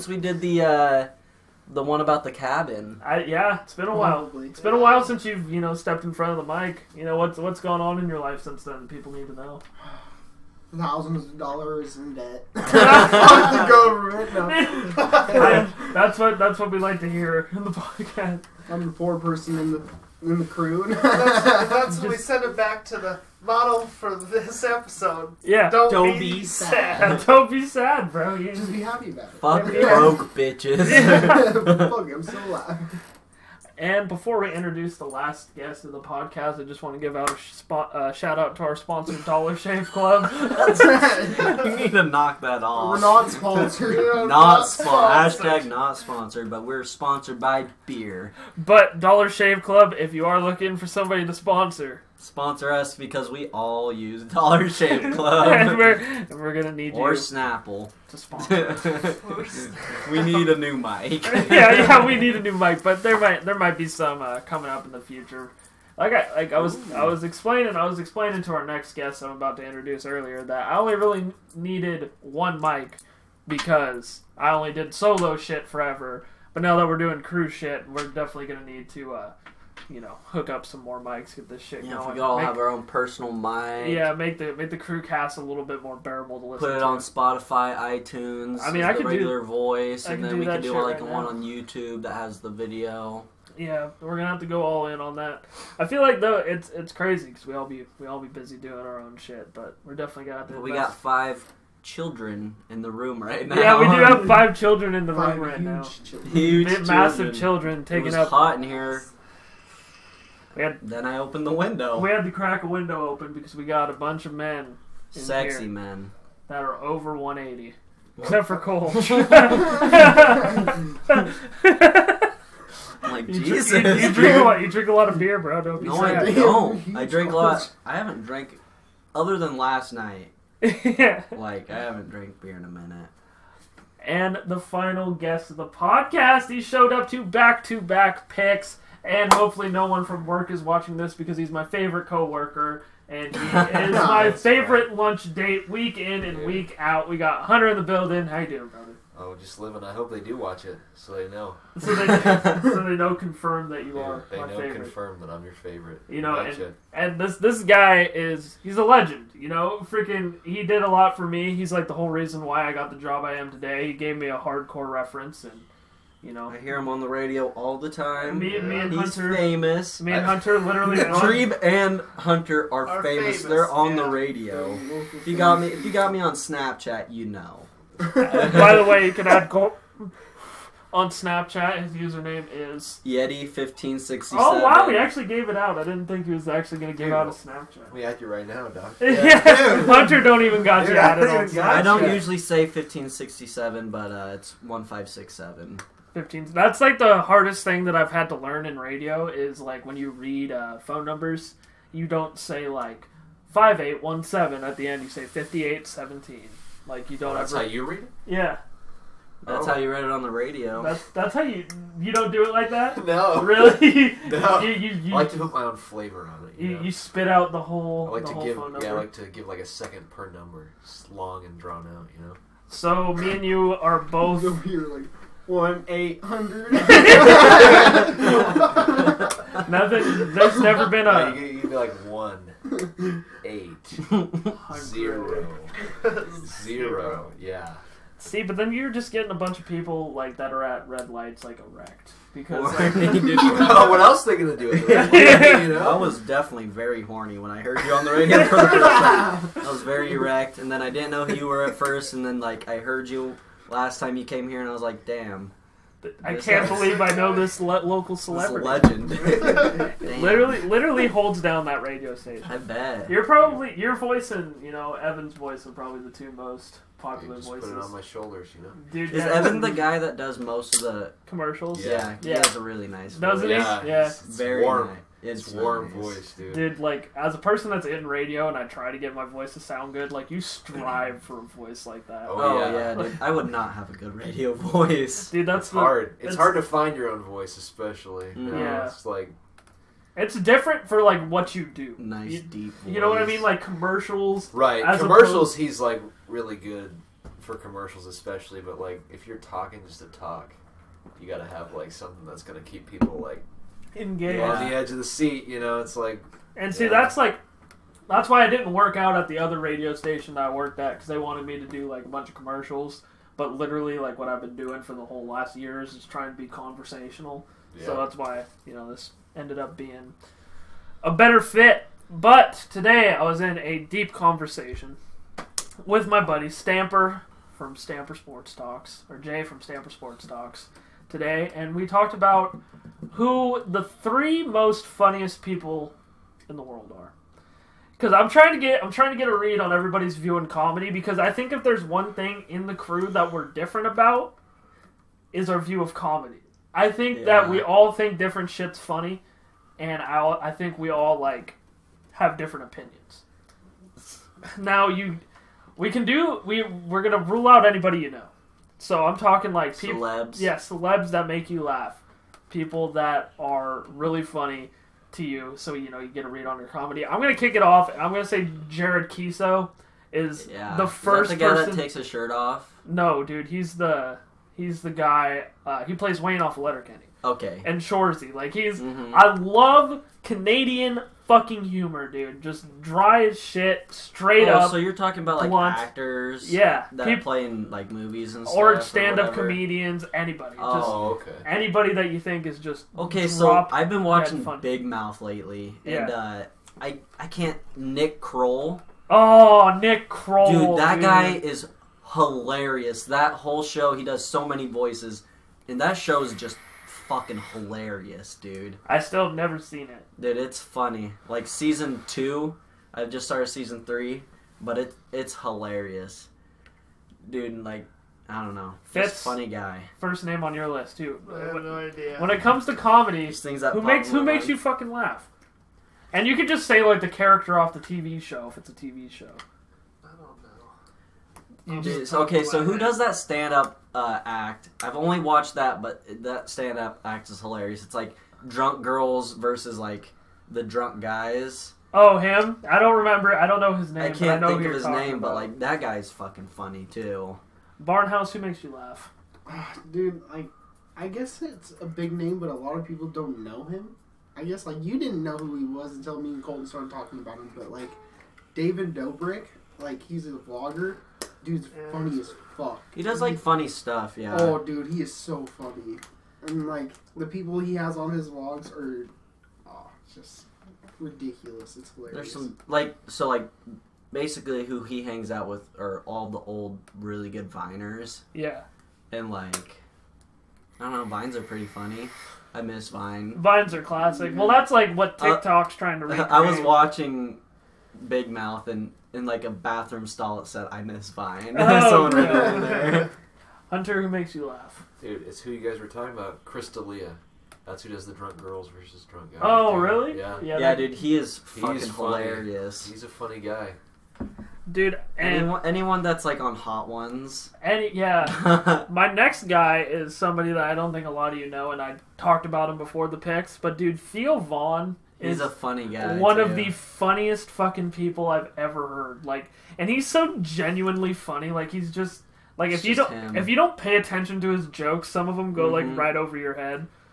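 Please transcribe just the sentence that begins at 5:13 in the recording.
But literally, like what I've been doing for the whole last year is just trying to be conversational.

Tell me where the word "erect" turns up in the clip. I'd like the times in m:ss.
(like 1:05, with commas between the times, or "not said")
4:01, 4:10.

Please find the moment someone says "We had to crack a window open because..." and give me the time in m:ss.
1:51.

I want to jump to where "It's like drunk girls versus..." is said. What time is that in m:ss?
7:17.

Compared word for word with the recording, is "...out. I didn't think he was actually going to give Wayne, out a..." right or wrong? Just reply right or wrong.
wrong.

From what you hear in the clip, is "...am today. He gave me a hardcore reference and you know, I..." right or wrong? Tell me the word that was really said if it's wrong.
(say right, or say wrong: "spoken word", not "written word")
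right.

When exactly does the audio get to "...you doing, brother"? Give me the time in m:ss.
2:28.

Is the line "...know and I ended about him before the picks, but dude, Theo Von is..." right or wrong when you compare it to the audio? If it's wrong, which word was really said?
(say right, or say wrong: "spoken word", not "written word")
wrong: "talked", not "ended".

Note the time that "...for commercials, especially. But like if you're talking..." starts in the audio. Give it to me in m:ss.
4:57.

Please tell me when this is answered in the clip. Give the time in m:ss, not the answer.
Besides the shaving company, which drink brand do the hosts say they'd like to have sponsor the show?
0:57.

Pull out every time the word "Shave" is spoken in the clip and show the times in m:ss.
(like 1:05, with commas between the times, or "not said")
0:39, 0:49, 0:54.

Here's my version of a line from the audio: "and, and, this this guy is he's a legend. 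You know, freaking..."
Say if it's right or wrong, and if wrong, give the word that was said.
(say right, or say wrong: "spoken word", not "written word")
right.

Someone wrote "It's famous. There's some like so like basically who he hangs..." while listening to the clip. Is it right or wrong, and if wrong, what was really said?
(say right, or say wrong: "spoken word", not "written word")
wrong: "hilarious", not "famous".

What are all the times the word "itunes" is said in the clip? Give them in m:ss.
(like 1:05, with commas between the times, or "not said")
1:27.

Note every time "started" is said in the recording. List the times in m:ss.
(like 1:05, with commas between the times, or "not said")
6:53, 7:36.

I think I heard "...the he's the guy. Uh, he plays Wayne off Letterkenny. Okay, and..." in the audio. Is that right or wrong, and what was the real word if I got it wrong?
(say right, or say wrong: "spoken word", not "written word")
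right.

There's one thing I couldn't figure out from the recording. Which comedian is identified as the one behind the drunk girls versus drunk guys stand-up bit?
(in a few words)
Chris D'Elia.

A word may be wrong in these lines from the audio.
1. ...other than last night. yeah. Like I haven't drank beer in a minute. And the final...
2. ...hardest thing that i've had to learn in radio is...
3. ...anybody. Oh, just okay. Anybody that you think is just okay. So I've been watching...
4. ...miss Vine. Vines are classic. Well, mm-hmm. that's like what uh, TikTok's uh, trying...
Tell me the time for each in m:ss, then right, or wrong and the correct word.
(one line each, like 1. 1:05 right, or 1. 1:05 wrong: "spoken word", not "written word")
1. 2:09 right
2. 3:17 right
3. 6:30 right
4. 8:02 right.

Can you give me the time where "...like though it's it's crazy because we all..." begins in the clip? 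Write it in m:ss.
1:36.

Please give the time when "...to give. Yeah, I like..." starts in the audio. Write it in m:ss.
3:38.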